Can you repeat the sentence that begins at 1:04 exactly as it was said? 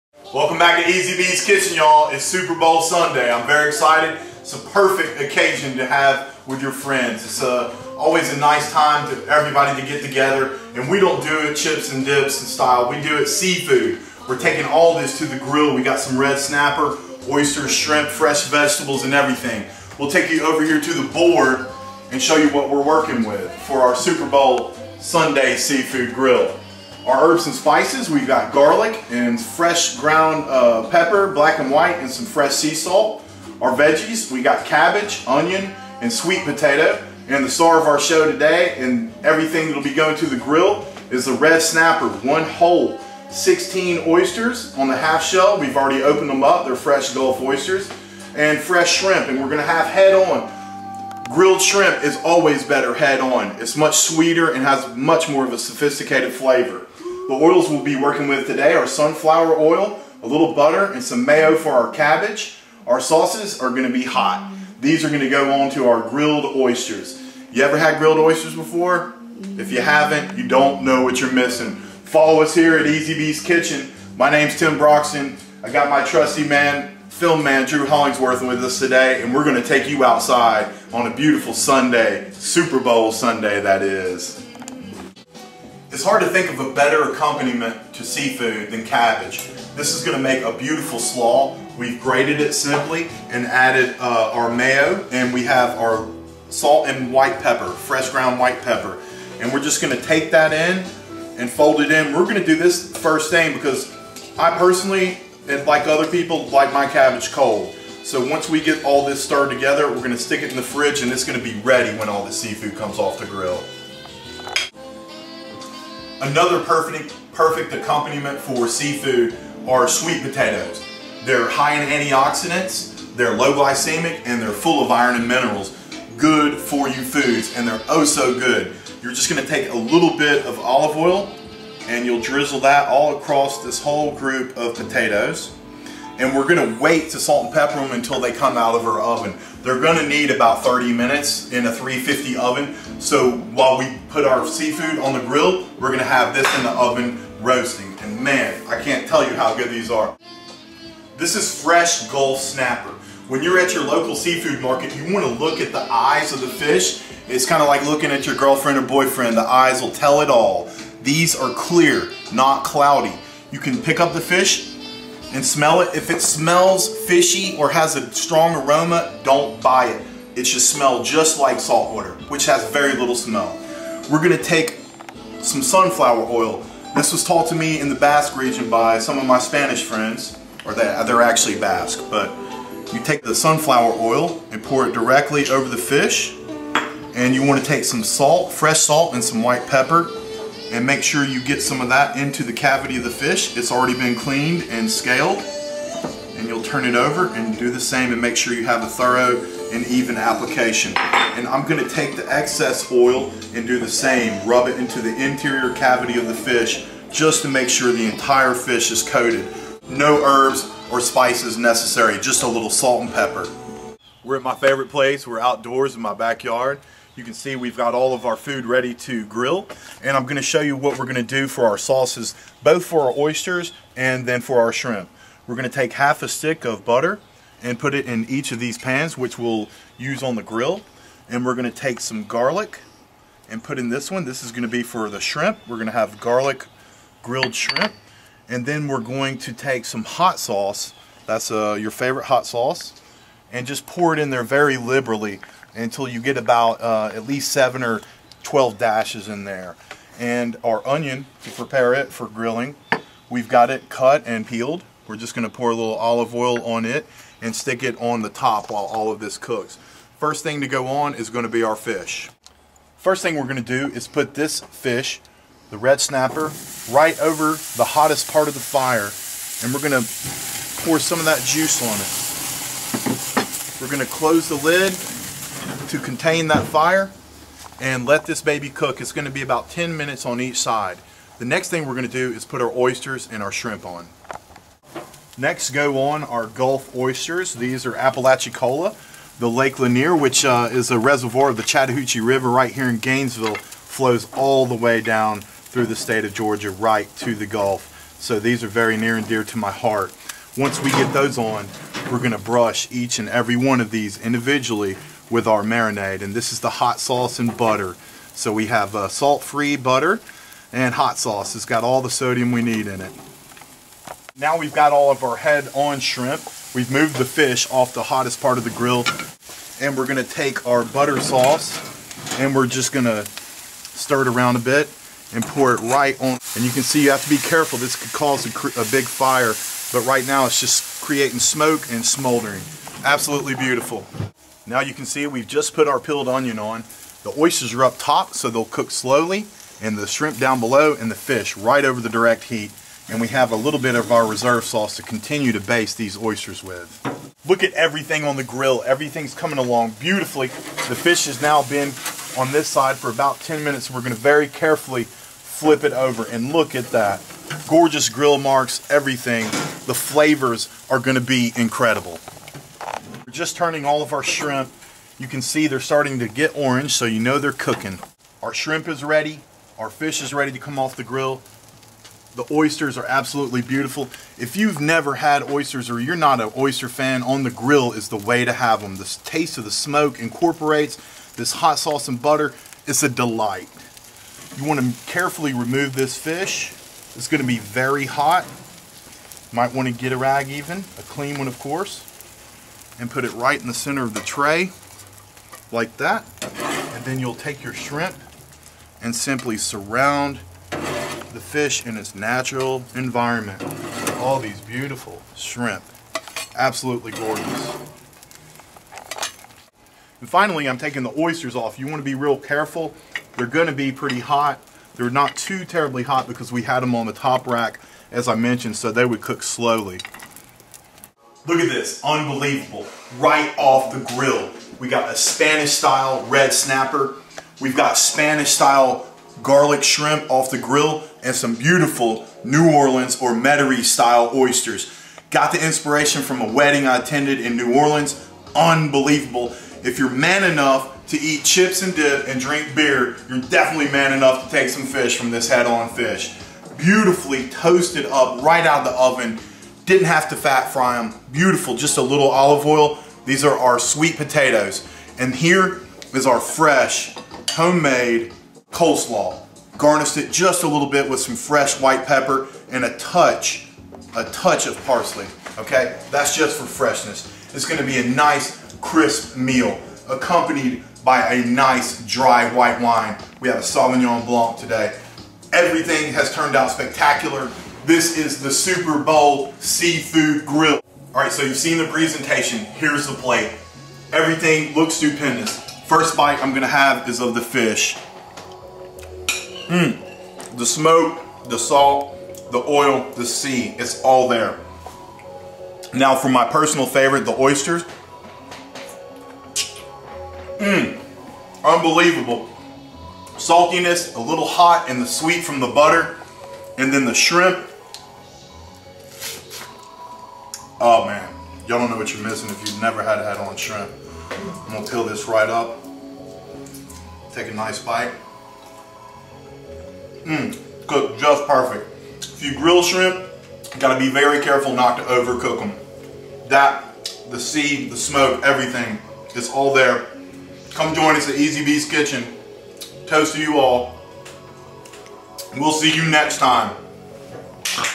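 These are going to go on to our grilled oysters.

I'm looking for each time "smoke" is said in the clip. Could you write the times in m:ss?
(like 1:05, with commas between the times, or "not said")
5:31, 6:19, 8:10, 8:47.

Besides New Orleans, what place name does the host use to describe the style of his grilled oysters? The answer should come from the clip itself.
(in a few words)
Metairie.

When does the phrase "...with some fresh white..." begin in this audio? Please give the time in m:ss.
7:41.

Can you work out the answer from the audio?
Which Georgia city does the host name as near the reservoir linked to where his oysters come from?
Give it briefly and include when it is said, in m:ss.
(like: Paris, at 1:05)
Gainesville, at 4:52.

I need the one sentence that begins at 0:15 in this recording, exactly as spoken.
We got some red snapper, oysters, shrimp, fresh vegetables, and everything.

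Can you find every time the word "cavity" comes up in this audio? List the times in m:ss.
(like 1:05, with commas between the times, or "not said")
3:12, 3:25.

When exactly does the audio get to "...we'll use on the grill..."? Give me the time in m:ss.
3:49.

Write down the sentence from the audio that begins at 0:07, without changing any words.
It's a, uh, always a nice time to everybody to get together.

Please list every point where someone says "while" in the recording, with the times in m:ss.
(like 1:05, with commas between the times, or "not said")
2:23, 4:18.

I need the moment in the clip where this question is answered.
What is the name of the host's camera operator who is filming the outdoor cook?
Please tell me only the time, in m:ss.
1:17.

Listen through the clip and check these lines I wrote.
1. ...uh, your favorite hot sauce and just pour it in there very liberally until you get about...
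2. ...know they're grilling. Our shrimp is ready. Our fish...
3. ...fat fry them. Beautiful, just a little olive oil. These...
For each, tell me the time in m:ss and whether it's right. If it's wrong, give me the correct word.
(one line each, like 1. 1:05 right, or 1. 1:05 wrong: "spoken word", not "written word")
1. 4:01 right
2. 6:07 wrong: "cooking", not "grilling"
3. 7:30 right.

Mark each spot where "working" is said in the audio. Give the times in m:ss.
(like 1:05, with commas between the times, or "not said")
0:22, 0:57.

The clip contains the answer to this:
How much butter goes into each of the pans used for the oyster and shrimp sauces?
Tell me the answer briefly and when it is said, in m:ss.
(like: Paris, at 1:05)
Half a stick, at 3:45.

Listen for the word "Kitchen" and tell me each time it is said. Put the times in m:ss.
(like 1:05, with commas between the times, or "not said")
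0:01, 1:13, 8:51.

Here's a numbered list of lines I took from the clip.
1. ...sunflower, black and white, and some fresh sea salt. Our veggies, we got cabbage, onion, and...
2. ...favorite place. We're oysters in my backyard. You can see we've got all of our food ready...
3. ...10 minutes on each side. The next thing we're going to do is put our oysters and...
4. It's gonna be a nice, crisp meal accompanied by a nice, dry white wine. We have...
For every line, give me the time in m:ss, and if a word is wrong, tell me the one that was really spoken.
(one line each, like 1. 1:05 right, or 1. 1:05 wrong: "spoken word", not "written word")
1. 0:30 wrong: "pepper", not "sunflower"
2. 3:34 wrong: "outdoors", not "oysters"
3. 4:39 right
4. 7:47 right.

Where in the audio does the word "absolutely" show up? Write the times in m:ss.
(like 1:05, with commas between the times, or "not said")
5:33, 6:13, 6:46.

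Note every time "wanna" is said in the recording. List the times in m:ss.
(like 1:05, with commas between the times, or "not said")
2:35, 3:07.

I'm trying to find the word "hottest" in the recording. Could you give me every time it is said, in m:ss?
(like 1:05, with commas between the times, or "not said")
4:27, 5:18.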